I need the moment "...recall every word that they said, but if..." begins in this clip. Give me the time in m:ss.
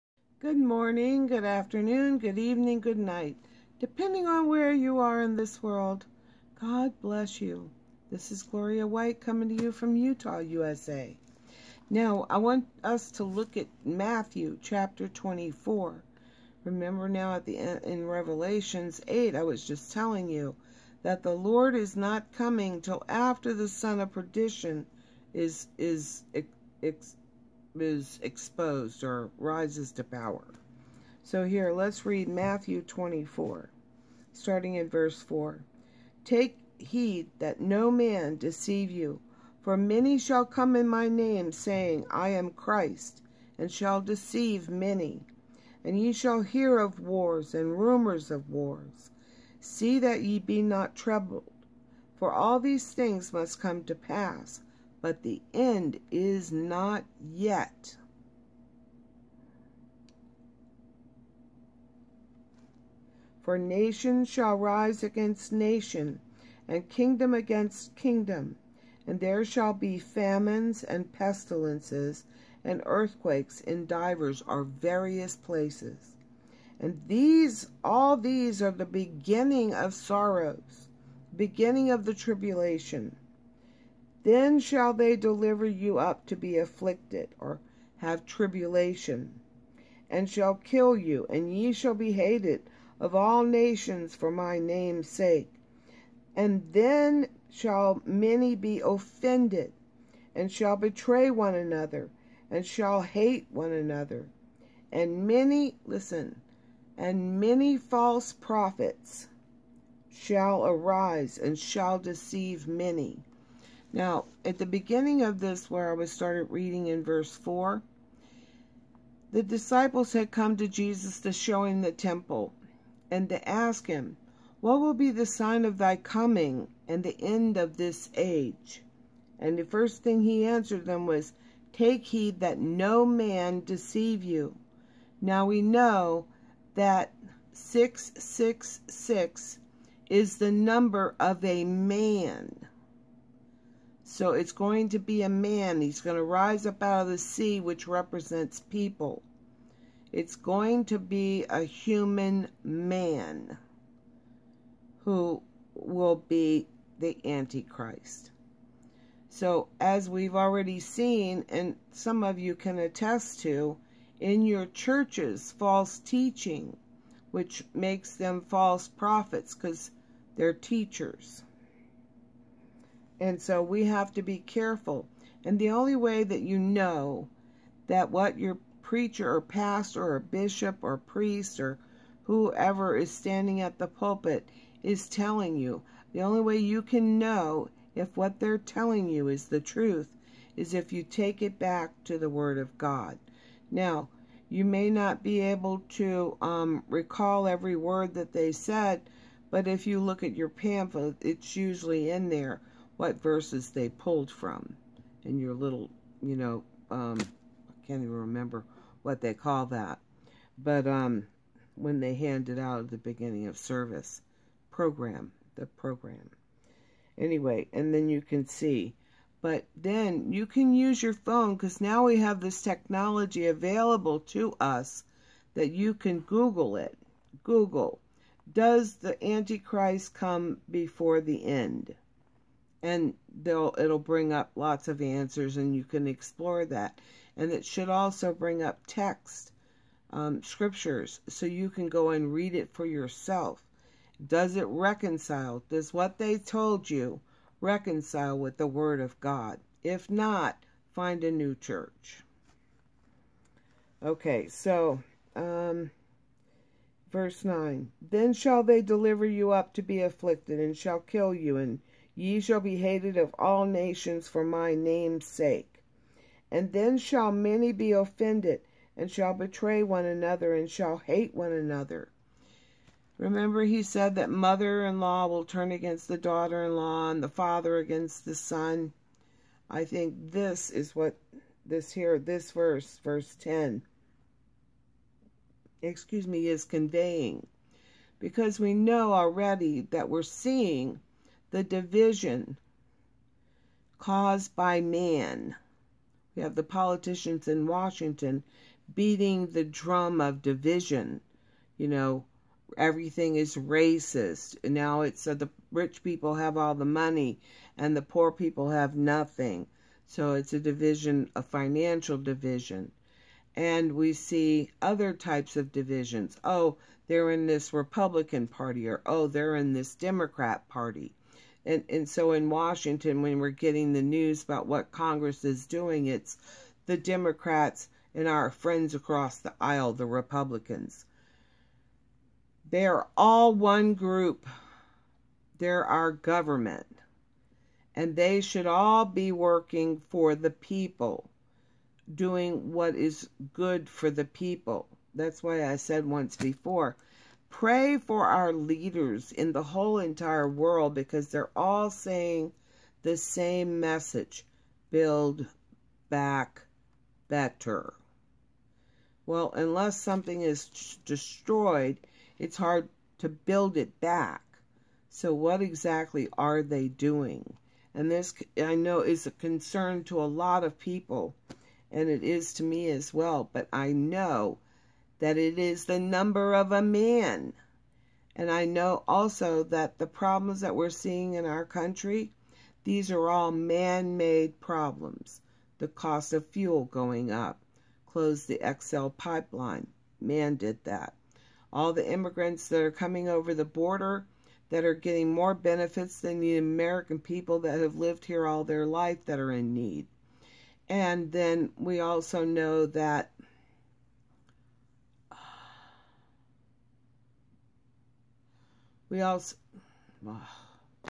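3:16.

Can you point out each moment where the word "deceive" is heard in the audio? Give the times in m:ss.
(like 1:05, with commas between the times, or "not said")
0:38, 0:44, 1:51, 2:13.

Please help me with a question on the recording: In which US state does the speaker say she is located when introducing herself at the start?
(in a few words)
Utah.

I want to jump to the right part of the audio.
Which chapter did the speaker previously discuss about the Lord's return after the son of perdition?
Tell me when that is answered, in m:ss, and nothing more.
0:18.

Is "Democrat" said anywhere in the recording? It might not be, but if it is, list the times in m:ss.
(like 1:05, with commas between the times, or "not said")
5:19, 5:26.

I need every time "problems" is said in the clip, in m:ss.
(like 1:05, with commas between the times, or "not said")
6:20, 6:24.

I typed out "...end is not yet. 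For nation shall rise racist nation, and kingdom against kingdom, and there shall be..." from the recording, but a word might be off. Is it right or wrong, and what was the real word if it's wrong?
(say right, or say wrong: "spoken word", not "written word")
wrong: "against", not "racist".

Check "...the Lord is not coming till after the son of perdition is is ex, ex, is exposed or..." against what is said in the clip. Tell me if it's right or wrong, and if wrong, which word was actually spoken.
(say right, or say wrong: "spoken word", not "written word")
right.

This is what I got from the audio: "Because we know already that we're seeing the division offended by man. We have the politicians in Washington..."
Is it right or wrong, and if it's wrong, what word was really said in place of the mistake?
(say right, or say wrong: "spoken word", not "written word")
wrong: "caused", not "offended".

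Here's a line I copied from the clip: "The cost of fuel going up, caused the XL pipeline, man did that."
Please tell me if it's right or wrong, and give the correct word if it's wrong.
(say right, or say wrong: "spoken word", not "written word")
wrong: "closed", not "caused".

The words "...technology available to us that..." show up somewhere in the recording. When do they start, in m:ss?
3:42.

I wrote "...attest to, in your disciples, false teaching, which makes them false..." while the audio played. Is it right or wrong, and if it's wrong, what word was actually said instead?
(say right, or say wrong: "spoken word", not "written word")
wrong: "churches", not "disciples".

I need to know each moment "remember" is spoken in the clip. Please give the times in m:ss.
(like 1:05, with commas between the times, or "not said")
0:16, 3:28, 4:33.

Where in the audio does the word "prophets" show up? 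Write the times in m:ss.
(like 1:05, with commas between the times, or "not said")
1:48, 2:48.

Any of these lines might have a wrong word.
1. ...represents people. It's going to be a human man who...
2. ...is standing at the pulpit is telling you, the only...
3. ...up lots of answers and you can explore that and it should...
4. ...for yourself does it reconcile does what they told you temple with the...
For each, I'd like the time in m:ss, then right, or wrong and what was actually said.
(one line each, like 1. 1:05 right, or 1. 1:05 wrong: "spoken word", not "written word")
1. 2:27 right
2. 3:02 right
3. 3:54 right
4. 4:02 wrong: "reconcile", not "temple".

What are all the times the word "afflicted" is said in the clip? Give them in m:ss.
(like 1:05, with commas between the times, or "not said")
1:26, 4:20.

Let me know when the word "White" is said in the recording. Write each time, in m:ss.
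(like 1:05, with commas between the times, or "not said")
0:08.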